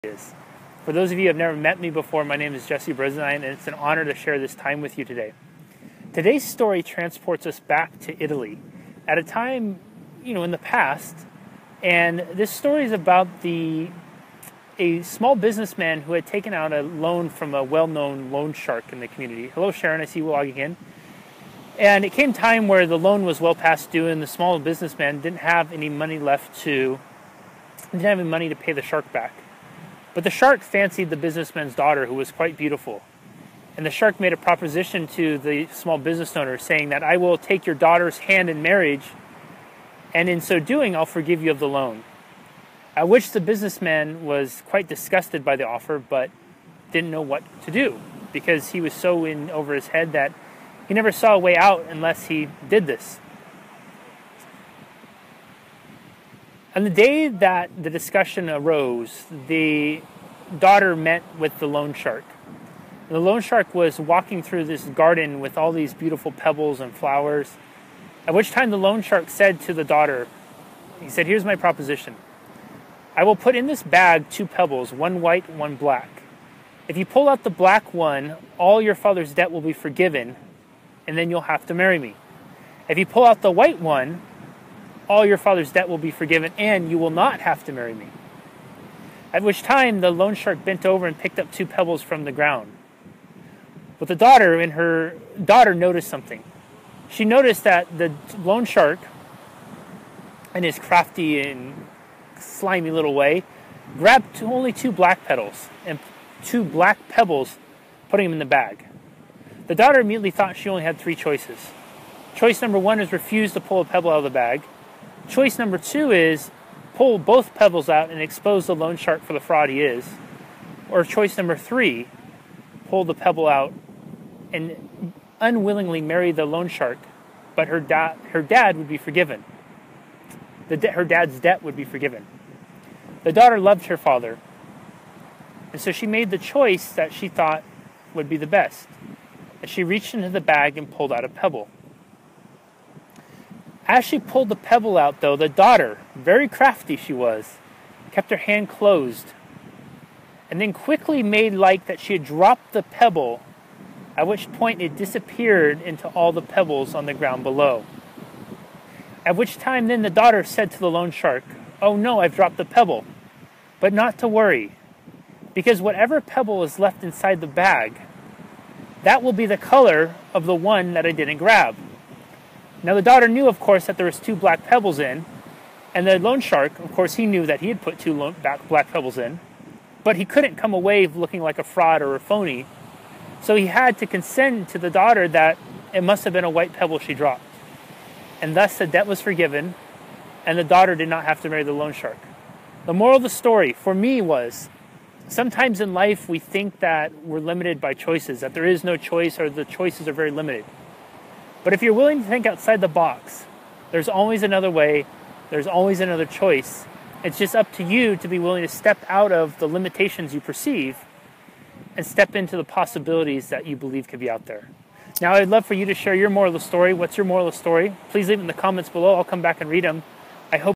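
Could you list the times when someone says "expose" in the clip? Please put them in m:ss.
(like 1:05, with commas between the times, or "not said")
1:58.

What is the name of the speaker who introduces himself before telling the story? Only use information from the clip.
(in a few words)
Jesse Brisendine.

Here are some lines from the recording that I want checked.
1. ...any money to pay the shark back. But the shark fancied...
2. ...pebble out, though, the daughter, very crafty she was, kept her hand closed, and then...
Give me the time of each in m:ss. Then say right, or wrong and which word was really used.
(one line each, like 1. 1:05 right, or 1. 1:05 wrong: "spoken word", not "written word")
1. 0:28 right
2. 2:24 right.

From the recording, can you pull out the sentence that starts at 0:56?
On the day that the discussion arose, the daughter met with the loan shark.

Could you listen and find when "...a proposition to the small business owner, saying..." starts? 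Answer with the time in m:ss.
0:34.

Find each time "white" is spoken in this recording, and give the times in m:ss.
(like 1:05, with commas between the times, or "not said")
1:15, 1:23, 3:06.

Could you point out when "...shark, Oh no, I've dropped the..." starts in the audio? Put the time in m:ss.
2:41.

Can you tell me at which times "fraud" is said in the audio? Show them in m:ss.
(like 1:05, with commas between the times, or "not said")
1:59, 3:01.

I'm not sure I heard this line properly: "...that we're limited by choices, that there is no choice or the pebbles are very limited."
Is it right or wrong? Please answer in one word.
wrong.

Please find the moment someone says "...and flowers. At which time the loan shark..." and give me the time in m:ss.
1:06.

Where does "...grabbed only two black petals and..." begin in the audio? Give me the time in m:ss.
1:43.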